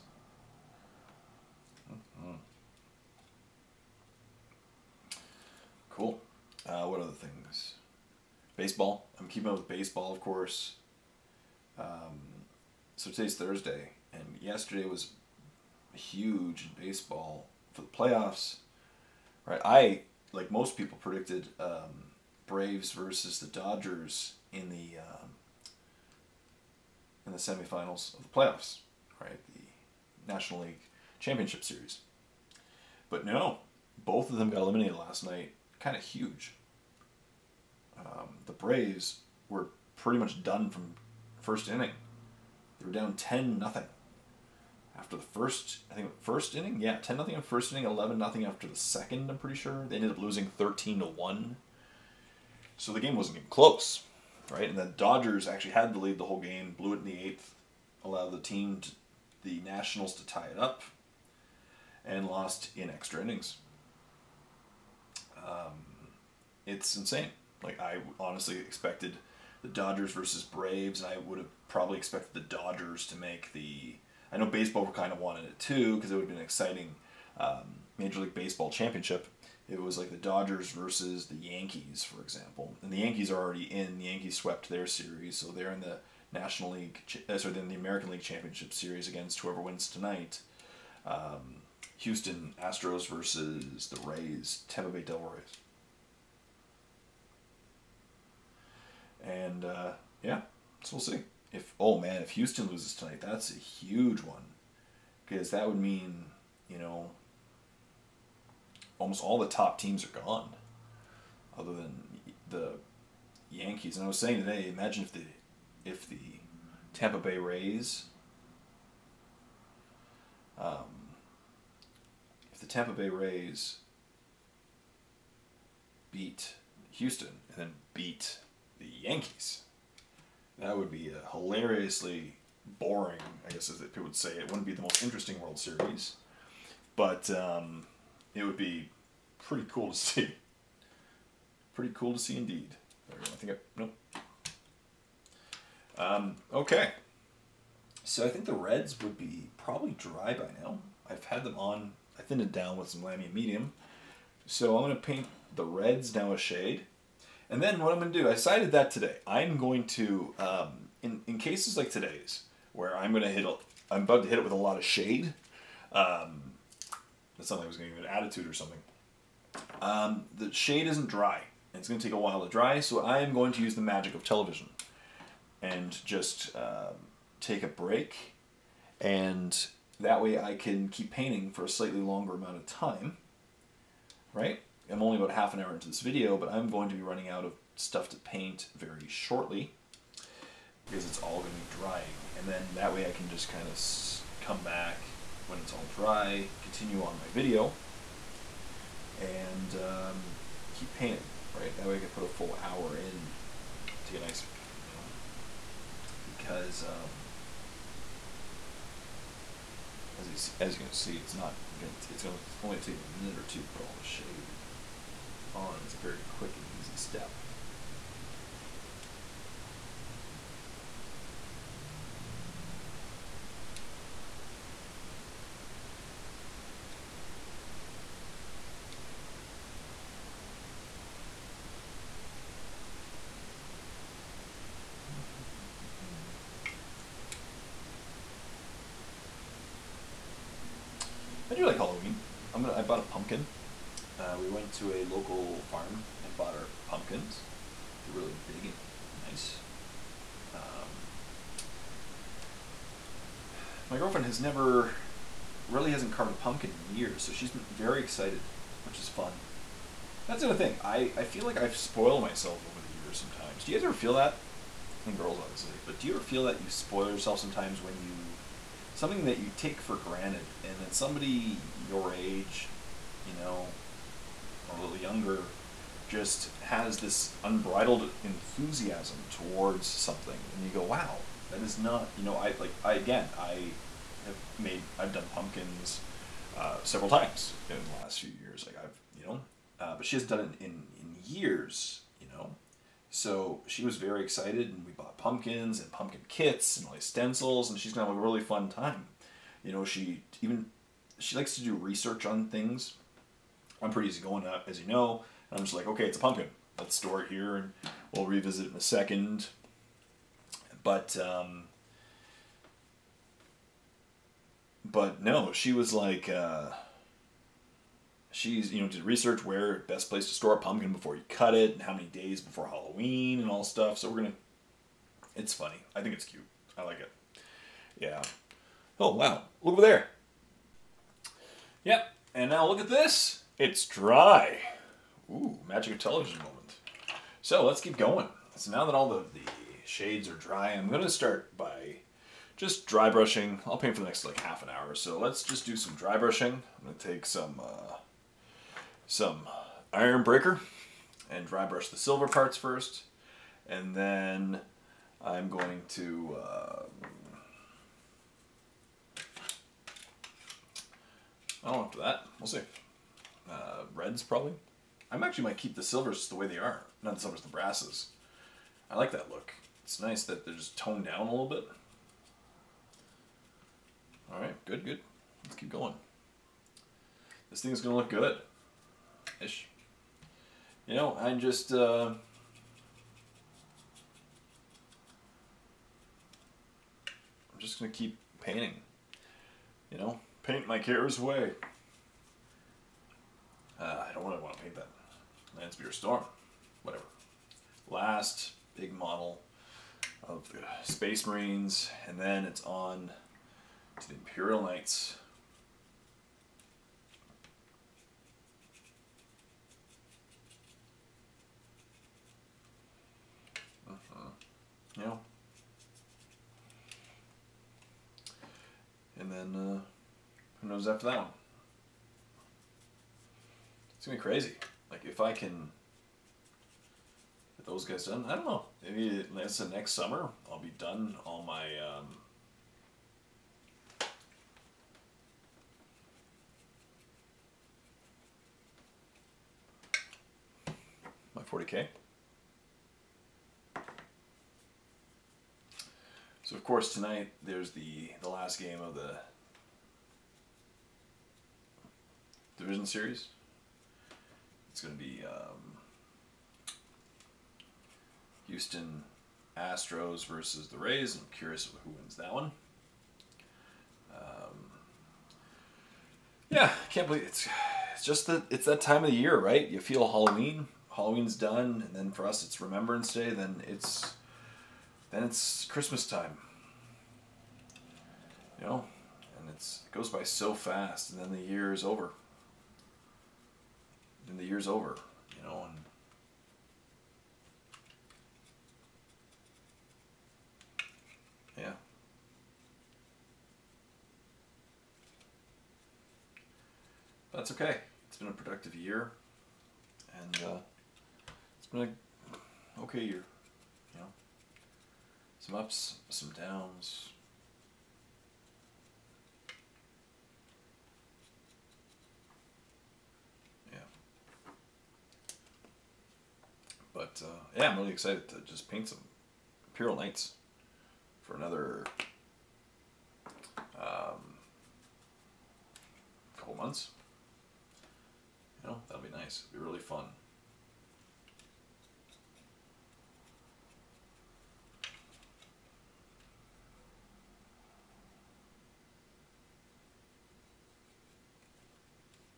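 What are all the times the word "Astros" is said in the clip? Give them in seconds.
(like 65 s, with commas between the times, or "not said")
92 s, 459 s.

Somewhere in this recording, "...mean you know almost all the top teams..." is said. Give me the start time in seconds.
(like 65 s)
105 s.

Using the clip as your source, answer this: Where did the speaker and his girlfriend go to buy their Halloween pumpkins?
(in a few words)
A local farm.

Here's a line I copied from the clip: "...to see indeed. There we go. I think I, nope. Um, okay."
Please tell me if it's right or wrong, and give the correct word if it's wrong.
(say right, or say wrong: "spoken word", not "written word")
right.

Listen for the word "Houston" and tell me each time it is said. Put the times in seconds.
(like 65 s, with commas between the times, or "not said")
91 s, 102 s, 126 s, 458 s.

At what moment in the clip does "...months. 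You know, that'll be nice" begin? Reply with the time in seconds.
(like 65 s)
526 s.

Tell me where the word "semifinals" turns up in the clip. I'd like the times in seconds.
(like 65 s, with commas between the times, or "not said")
27 s.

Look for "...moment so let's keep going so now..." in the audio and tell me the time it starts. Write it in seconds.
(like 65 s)
336 s.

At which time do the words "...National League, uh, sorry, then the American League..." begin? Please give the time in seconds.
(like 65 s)
86 s.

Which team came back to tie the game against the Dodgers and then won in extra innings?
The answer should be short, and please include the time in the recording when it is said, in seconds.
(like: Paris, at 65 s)
The Nationals, at 59 s.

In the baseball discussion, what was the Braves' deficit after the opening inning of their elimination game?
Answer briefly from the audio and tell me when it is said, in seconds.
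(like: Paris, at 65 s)
10-0, at 43 s.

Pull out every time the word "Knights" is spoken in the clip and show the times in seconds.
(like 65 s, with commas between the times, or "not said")
404 s, 519 s.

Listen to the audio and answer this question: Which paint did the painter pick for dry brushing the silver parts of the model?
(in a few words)
Ironbreaker.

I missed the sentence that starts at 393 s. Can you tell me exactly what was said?
Uh, I don't really want to paint that.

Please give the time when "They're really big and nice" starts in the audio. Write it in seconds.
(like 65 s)
248 s.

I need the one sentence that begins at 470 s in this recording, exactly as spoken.
Halloween's done, and then for us it's Remembrance Day.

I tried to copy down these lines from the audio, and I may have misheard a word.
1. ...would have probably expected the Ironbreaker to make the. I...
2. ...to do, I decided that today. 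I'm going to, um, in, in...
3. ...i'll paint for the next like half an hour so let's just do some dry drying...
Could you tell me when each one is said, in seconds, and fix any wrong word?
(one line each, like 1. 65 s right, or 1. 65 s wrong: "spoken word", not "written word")
1. 71 s wrong: "Dodgers", not "Ironbreaker"
2. 158 s right
3. 343 s wrong: "brushing", not "drying".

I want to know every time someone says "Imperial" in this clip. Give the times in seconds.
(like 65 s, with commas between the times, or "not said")
404 s, 519 s.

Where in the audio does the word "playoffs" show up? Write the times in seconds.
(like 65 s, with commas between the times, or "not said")
17 s, 28 s.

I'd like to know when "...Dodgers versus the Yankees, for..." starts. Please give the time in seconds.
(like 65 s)
80 s.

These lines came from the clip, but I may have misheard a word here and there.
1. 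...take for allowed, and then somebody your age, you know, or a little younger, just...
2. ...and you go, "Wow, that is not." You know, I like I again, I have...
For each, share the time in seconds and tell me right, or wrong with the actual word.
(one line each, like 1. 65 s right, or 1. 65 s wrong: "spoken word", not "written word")
1. 269 s wrong: "granted", not "allowed"
2. 280 s right.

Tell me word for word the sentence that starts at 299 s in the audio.
You know, she even she likes to do research on things.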